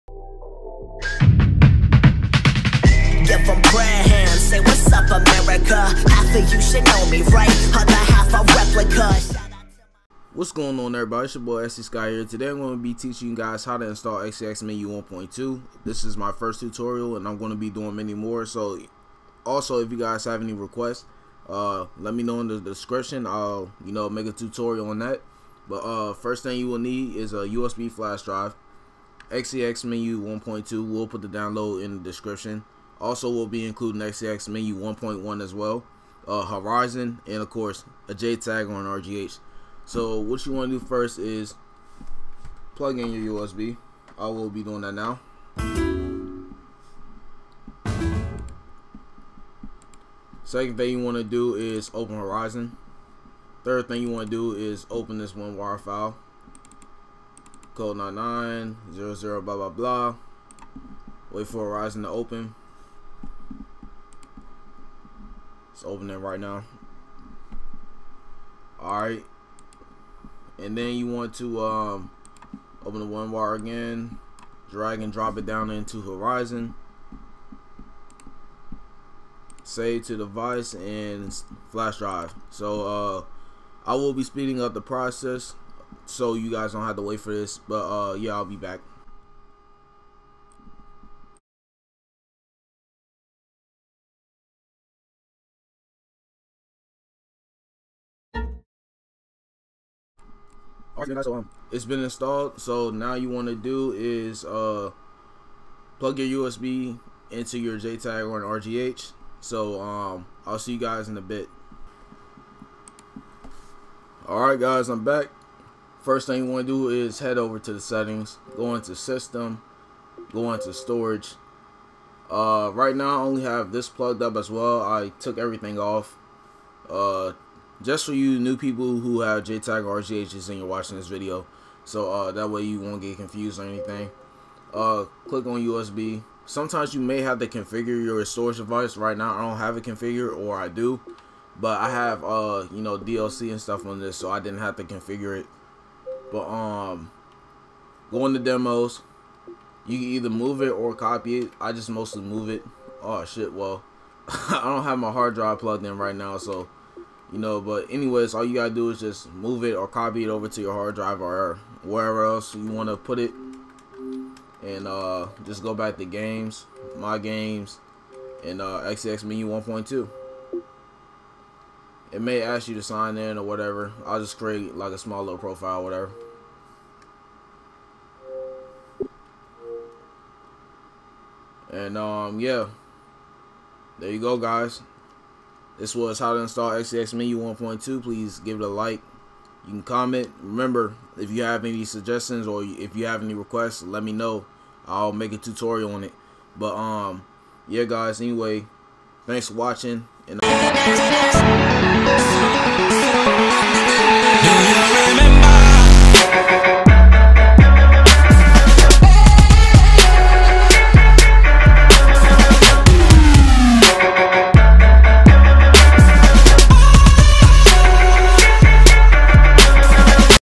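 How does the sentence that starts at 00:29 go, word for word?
XeXMenu 1.2, we'll put the download in the description.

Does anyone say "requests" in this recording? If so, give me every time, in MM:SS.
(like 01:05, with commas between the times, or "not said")
00:20, 03:13.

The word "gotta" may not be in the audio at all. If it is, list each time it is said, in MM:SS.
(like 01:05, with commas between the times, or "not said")
02:38.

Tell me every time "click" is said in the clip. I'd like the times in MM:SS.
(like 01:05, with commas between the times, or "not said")
02:15.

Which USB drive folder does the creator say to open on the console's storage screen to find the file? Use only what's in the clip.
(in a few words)
demos.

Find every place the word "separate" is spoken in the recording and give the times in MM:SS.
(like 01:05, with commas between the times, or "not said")
not said.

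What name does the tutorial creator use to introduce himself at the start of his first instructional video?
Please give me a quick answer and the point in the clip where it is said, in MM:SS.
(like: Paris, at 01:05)
SC Sky, at 00:11.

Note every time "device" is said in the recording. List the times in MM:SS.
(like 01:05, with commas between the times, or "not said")
01:20, 02:18.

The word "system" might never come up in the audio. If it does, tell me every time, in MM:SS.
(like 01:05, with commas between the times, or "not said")
01:58.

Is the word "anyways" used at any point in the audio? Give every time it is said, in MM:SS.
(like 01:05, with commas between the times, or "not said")
02:37, 03:18.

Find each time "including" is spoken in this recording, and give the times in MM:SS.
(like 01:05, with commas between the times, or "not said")
00:33.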